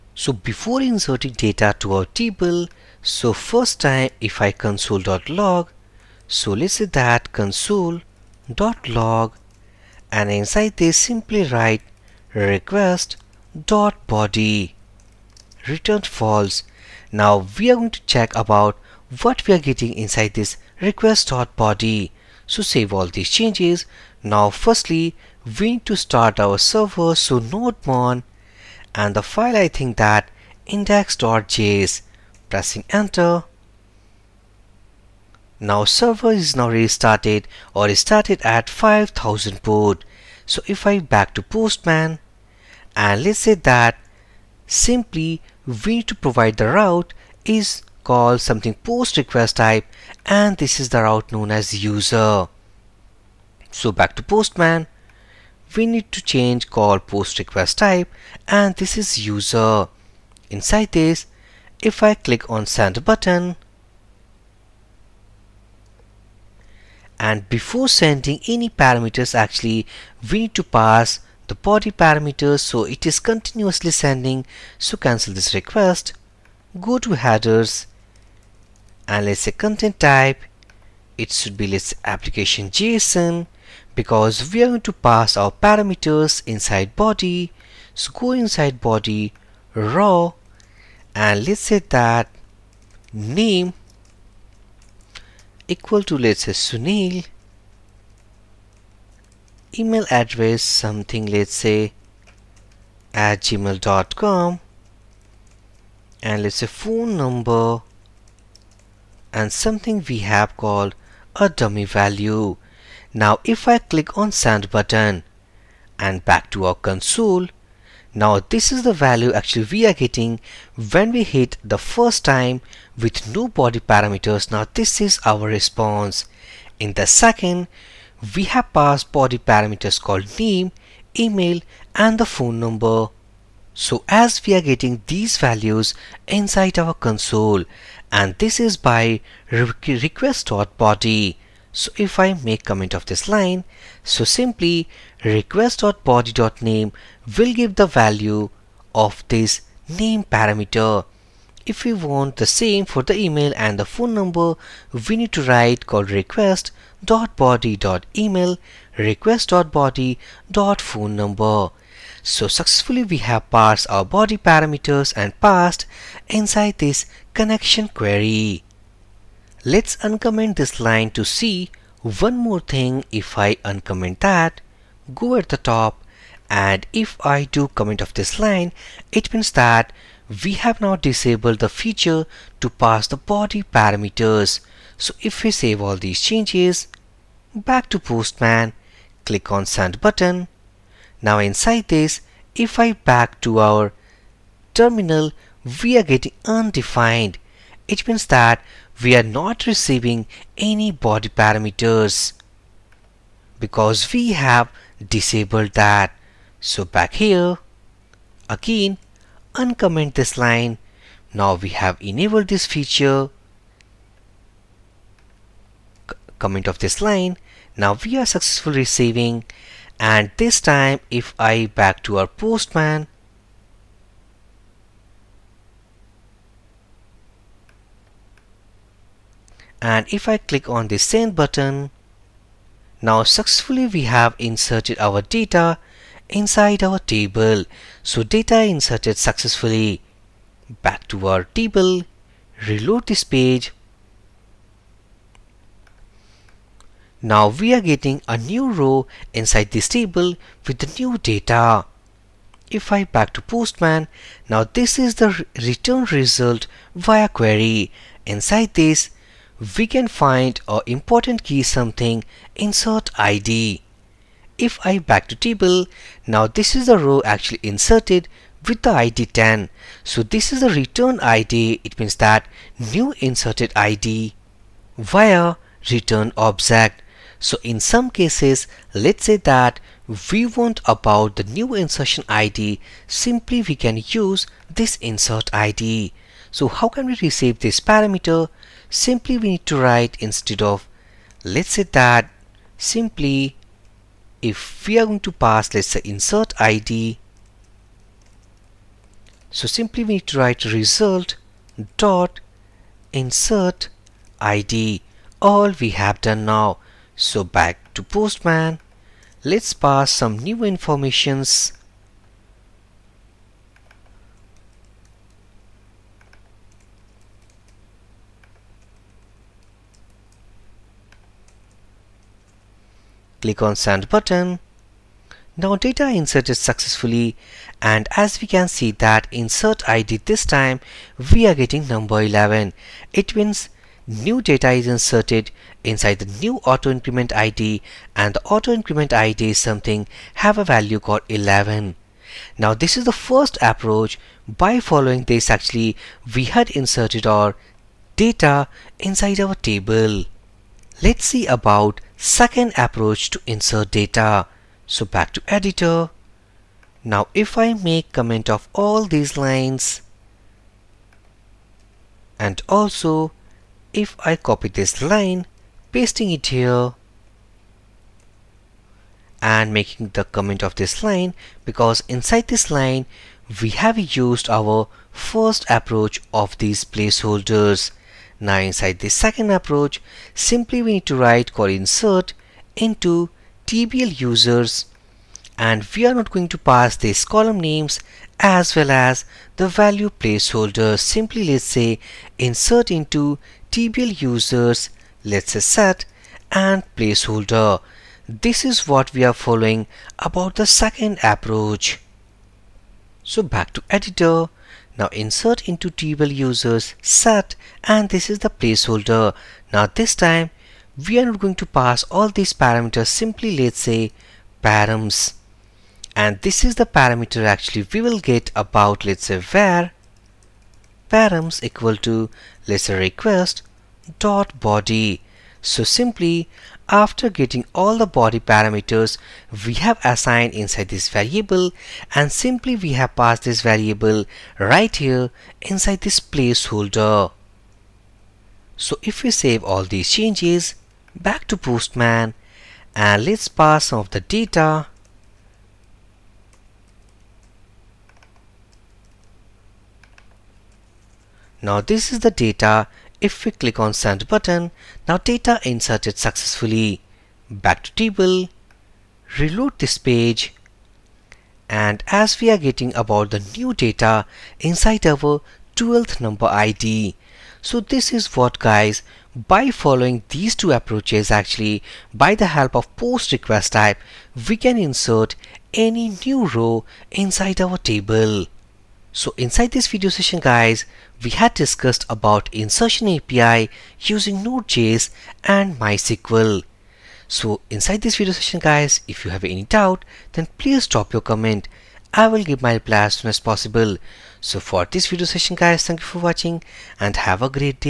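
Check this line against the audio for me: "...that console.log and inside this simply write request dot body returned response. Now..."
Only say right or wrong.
wrong.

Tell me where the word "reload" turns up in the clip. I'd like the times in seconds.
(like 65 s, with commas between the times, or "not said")
242 s, 459 s.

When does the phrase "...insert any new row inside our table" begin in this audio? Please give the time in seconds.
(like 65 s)
474 s.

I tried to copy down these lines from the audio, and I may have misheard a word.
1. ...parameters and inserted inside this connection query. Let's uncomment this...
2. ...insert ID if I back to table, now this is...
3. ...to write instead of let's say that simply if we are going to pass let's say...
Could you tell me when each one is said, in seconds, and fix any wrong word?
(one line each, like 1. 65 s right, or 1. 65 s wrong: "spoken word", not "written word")
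1. 164 s wrong: "passed", not "inserted"
2. 262 s right
3. 289 s right.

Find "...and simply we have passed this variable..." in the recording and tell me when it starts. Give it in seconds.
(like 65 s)
432 s.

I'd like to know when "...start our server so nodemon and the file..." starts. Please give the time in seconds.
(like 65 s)
25 s.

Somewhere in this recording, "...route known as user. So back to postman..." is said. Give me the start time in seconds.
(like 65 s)
51 s.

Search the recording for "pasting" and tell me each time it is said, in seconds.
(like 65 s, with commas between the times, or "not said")
365 s.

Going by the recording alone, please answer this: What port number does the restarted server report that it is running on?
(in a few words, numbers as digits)
5000.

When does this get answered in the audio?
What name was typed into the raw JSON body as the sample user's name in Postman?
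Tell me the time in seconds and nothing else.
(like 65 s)
96 s.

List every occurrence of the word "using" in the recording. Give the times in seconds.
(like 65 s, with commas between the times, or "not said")
483 s.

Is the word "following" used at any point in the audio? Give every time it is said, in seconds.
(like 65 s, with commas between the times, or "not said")
344 s, 399 s, 469 s.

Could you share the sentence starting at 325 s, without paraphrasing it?
Now data insert is successfully and as we can see that insert ID this time we are getting number 11.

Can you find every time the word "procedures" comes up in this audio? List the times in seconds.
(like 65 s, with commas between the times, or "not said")
not said.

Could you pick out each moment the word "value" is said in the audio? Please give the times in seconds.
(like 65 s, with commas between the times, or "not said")
111 s, 118 s, 135 s, 147 s, 340 s, 389 s.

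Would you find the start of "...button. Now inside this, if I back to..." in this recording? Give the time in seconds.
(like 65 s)
189 s.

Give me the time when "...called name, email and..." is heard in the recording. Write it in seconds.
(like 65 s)
129 s.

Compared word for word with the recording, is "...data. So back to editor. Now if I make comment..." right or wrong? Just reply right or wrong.
right.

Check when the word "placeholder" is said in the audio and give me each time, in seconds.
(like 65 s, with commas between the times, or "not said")
376 s, 390 s, 396 s, 408 s, 436 s.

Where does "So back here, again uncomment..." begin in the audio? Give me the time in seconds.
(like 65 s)
206 s.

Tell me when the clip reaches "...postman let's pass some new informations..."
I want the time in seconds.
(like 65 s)
308 s.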